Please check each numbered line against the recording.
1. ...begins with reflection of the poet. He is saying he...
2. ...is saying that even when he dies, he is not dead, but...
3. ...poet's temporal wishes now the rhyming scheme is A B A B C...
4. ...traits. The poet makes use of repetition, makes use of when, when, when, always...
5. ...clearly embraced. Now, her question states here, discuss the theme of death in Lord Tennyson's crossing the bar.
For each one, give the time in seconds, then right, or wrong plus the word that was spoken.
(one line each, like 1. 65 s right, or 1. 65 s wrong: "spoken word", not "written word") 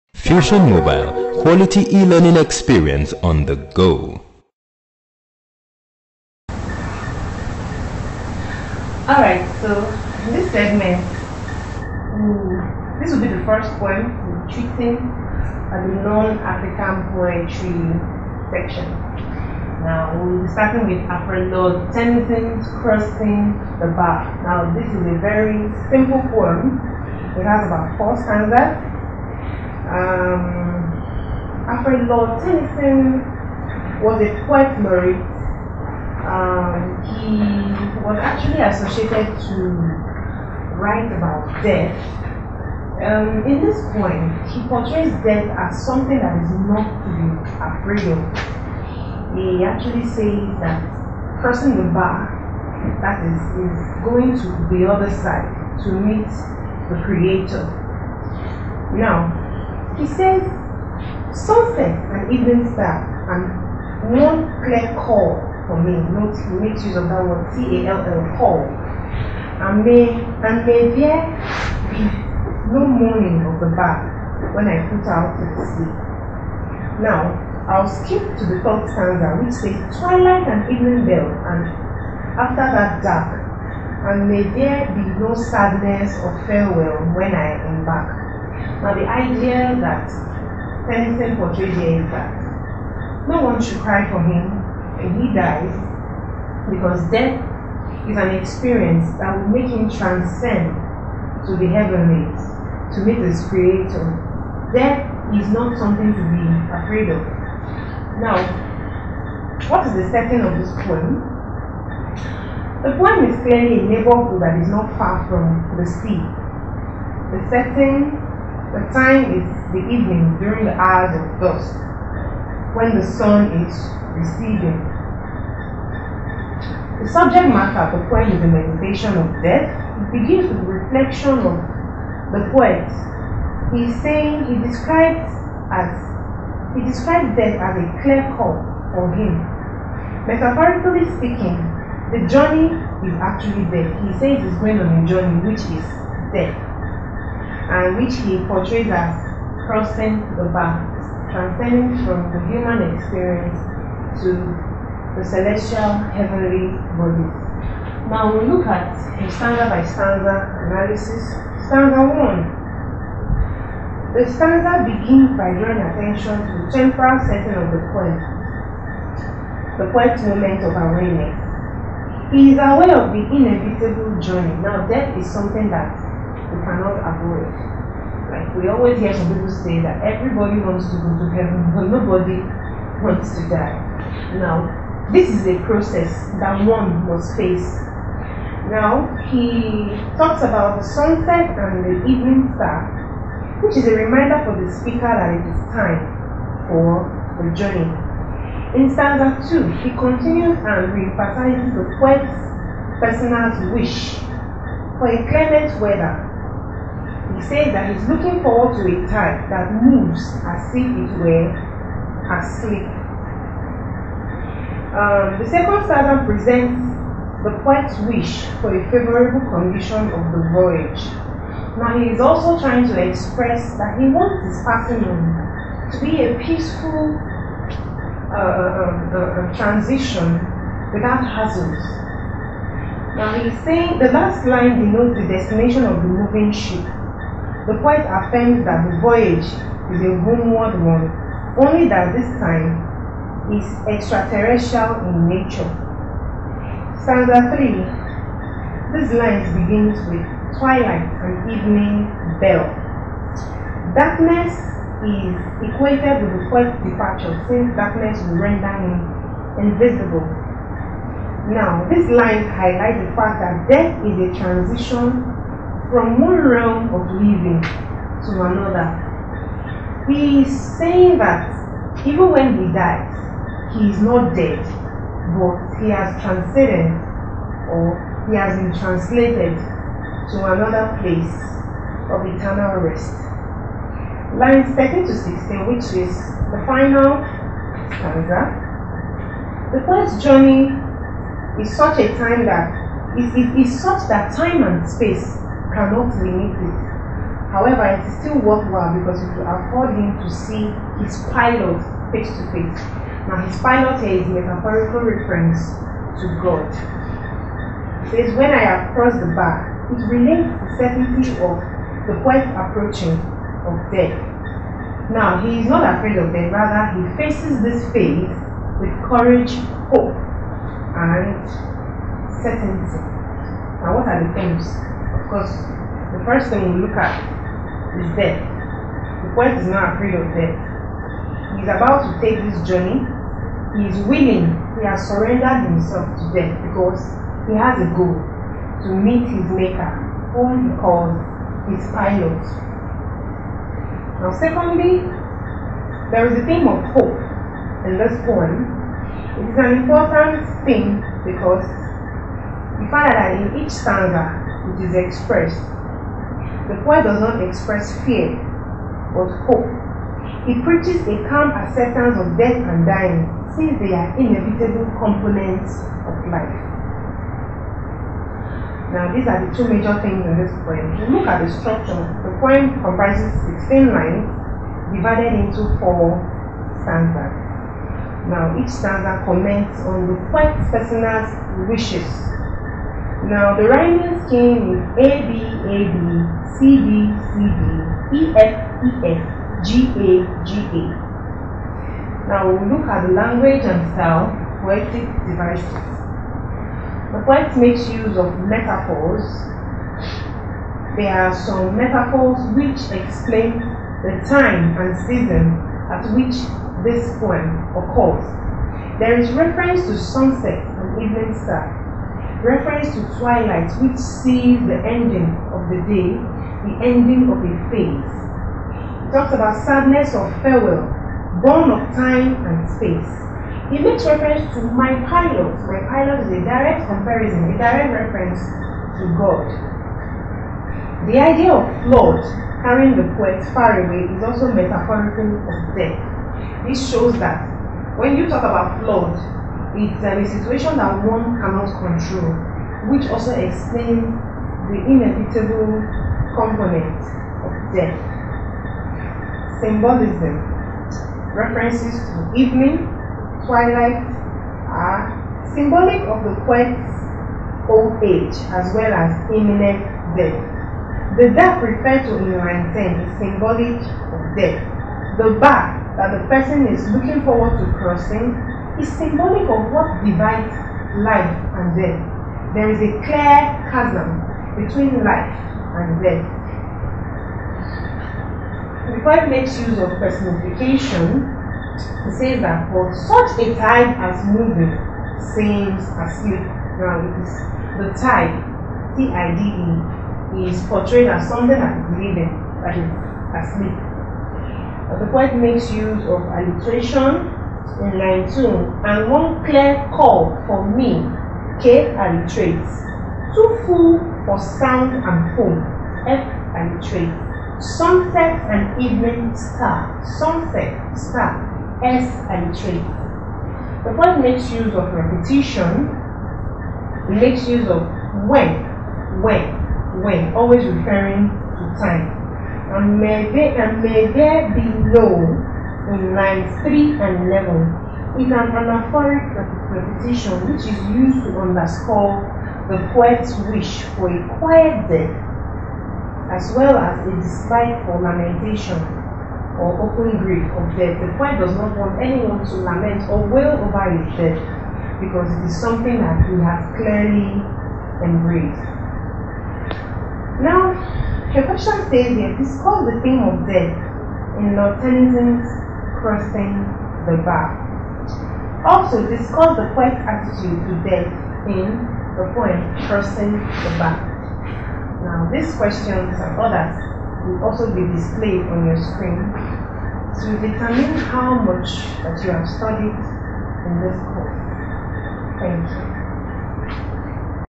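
1. 130 s right
2. 270 s right
3. 380 s wrong: "personal", not "temporal"
4. 512 s right
5. 546 s right.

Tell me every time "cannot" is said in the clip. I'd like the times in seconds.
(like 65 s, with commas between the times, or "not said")
176 s, 295 s, 441 s.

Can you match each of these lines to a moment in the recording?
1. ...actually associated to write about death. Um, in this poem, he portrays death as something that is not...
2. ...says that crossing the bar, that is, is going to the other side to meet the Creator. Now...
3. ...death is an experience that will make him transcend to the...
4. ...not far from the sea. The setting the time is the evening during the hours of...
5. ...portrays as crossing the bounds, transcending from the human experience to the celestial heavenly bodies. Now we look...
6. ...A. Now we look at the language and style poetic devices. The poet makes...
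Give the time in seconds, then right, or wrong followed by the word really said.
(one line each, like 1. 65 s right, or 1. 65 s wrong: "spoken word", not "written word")
1. 38 s right
2. 50 s right
3. 97 s right
4. 114 s right
5. 148 s right
6. 390 s right.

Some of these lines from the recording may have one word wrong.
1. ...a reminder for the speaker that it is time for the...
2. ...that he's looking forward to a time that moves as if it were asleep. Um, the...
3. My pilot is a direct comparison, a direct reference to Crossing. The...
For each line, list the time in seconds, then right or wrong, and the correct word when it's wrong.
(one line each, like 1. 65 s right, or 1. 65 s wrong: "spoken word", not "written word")
1. 193 s right
2. 207 s right
3. 425 s wrong: "God", not "Crossing".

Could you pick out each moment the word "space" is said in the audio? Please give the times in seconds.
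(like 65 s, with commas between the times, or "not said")
294 s, 422 s.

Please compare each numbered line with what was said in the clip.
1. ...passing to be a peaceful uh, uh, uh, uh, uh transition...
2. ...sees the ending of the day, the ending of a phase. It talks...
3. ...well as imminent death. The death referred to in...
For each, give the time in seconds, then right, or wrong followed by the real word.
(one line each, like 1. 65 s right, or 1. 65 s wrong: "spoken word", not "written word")
1. 224 s right
2. 413 s right
3. 458 s right.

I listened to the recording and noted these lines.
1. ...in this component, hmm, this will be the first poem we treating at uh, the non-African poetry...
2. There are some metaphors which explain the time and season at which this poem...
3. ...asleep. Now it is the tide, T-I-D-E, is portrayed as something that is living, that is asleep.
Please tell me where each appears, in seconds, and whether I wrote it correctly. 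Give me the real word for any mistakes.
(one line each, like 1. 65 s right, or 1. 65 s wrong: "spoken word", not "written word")
1. 10 s wrong: "segment", not "component"
2. 400 s right
3. 485 s right.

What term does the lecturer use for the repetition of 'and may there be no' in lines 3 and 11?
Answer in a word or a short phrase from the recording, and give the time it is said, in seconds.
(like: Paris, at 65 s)
anaphoric repetition, at 528 s.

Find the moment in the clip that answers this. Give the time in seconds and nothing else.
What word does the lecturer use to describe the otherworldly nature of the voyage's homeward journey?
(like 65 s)
243 s.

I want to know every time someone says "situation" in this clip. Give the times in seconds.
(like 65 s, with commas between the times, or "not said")
440 s.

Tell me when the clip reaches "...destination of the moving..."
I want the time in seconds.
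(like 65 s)
235 s.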